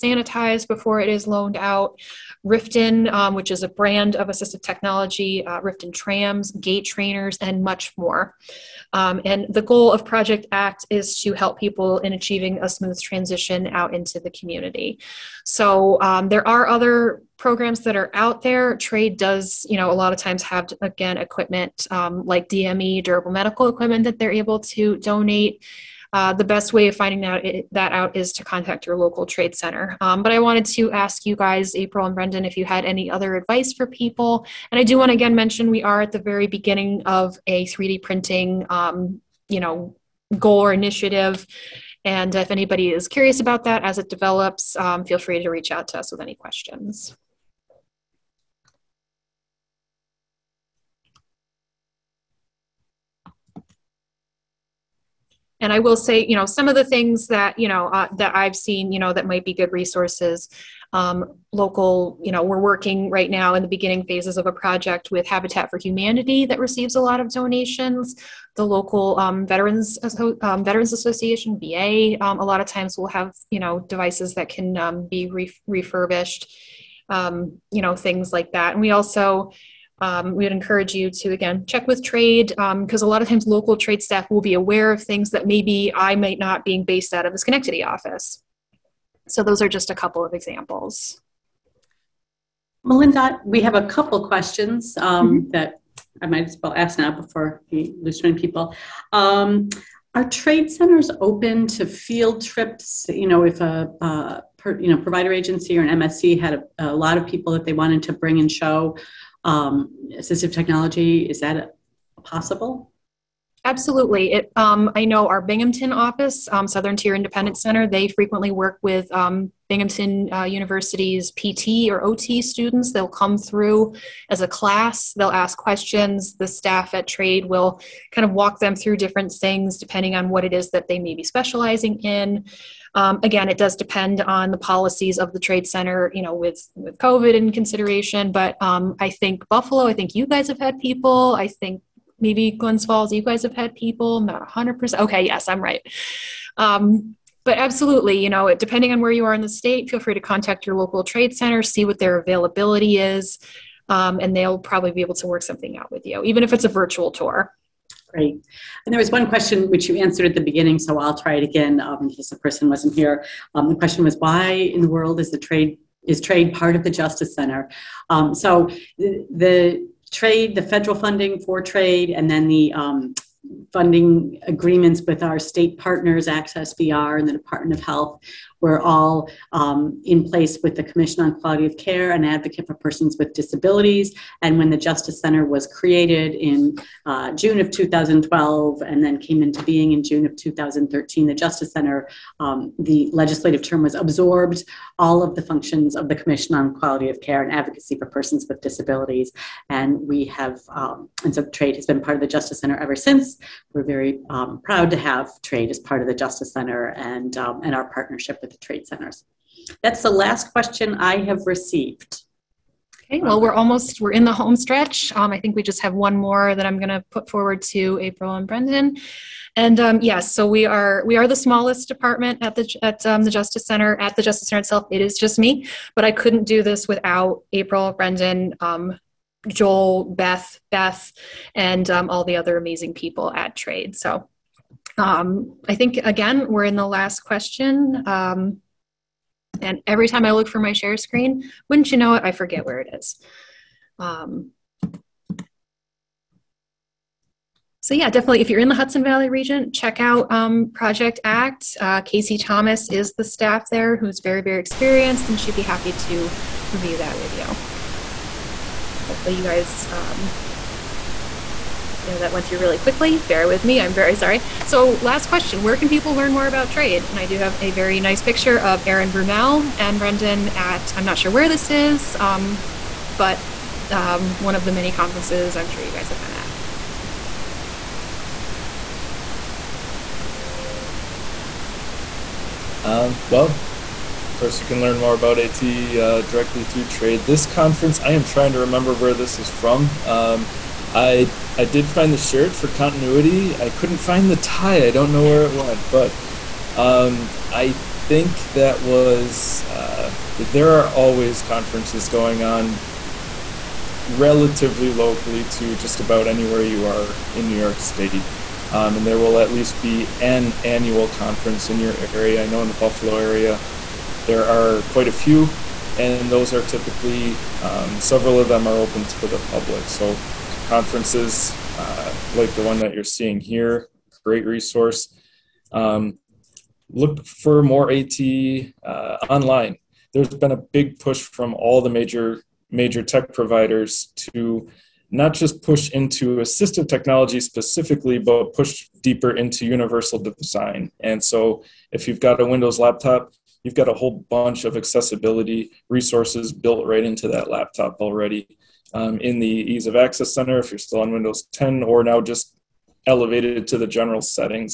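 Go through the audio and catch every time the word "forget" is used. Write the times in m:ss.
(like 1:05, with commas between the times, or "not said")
4:02.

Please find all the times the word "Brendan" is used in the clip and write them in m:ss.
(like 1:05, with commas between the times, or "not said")
0:32, 3:38, 3:47, 4:29.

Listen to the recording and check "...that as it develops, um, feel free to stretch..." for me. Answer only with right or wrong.
wrong.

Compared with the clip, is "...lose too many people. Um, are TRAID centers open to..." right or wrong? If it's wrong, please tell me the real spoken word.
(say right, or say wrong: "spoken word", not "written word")
right.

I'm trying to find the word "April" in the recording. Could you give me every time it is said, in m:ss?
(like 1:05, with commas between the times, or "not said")
0:31, 3:38, 3:47.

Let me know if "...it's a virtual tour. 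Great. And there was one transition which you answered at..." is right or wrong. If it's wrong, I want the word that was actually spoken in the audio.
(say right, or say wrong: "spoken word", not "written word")
wrong: "question", not "transition".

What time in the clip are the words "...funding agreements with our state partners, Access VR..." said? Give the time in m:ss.
2:53.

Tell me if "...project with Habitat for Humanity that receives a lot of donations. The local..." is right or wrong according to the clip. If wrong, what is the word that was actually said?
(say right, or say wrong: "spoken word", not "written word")
right.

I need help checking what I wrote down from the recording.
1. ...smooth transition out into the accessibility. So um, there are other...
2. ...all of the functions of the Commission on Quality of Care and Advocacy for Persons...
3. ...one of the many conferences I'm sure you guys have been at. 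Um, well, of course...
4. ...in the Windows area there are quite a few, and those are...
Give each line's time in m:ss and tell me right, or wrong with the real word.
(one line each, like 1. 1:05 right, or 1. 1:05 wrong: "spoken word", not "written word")
1. 0:12 wrong: "community", not "accessibility"
2. 3:14 right
3. 4:34 right
4. 5:12 wrong: "Buffalo", not "Windows".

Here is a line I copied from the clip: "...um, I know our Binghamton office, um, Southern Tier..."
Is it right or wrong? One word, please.
right.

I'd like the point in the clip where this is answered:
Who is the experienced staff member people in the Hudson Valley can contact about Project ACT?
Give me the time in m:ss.
4:12.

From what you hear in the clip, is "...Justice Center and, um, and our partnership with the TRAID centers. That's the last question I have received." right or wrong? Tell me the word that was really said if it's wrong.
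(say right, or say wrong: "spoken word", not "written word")
right.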